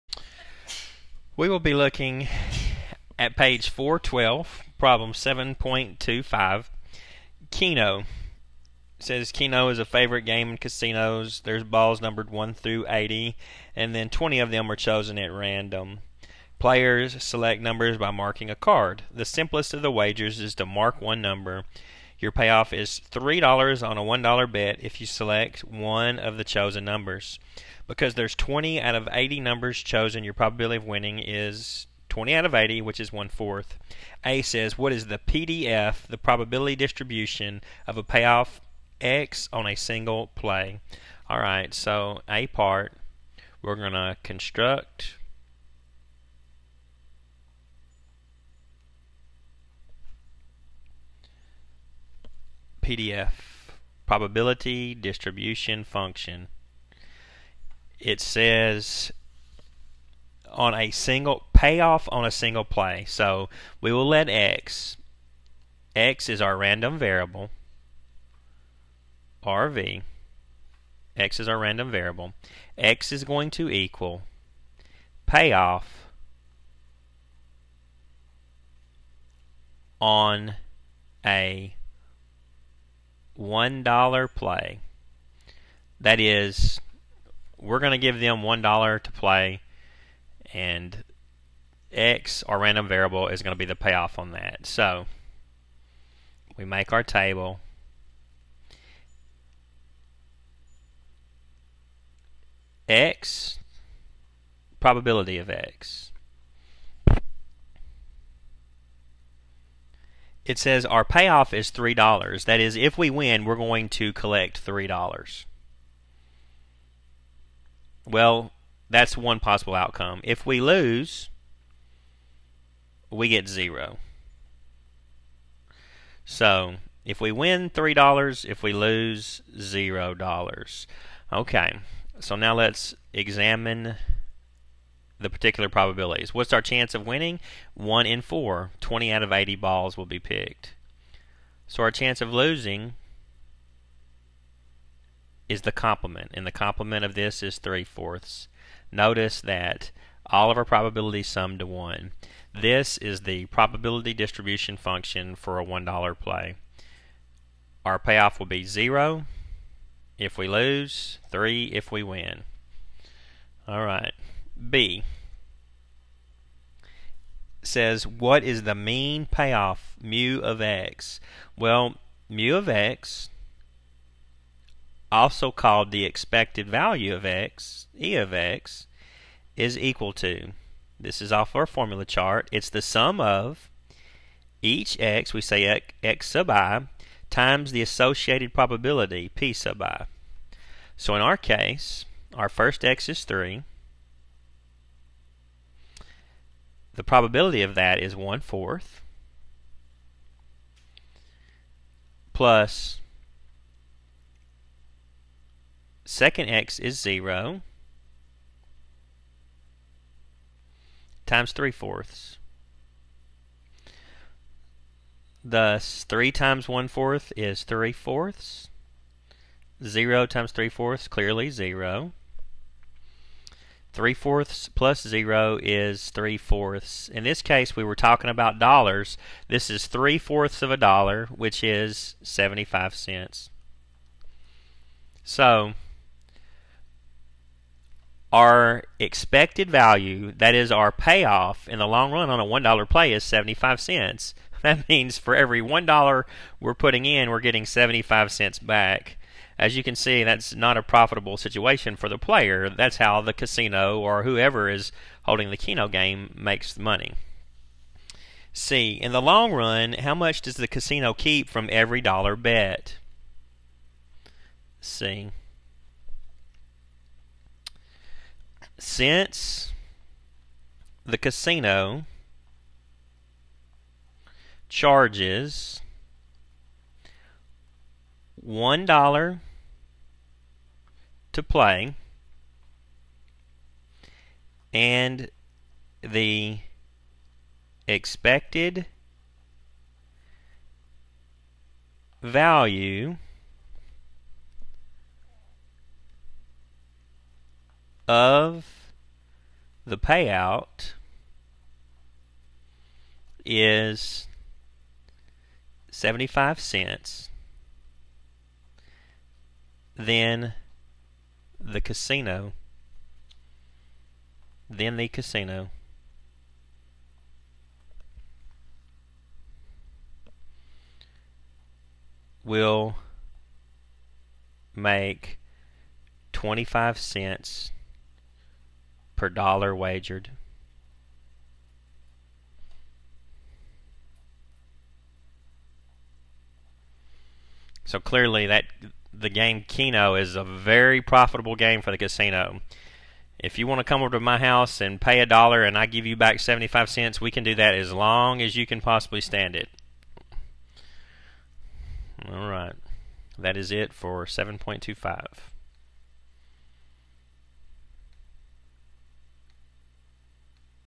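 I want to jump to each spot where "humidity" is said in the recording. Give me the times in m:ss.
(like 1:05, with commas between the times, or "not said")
not said.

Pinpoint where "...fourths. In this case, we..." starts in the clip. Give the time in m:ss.
3:46.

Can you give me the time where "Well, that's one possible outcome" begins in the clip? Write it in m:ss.
1:58.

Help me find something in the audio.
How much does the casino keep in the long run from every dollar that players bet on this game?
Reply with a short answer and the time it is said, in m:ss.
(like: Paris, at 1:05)
25 cents, at 5:26.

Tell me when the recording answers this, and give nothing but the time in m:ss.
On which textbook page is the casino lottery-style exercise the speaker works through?
0:03.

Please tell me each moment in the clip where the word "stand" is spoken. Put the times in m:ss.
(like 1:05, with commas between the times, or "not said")
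5:49.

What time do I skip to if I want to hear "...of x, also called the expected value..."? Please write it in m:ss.
2:52.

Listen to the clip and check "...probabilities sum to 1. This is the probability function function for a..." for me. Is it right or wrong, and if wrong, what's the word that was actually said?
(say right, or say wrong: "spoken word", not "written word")
wrong: "distribution", not "function".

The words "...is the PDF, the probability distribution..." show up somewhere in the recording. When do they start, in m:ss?
0:34.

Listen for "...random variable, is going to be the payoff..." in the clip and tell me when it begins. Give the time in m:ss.
1:32.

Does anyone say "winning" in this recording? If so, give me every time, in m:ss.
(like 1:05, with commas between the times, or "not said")
0:30, 2:17.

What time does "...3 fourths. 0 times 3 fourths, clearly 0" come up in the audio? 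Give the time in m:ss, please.
3:37.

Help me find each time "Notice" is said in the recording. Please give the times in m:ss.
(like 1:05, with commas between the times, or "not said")
2:28.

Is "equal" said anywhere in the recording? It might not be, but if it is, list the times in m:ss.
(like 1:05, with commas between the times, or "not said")
1:13, 2:59.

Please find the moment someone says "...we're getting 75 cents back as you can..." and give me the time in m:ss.
4:07.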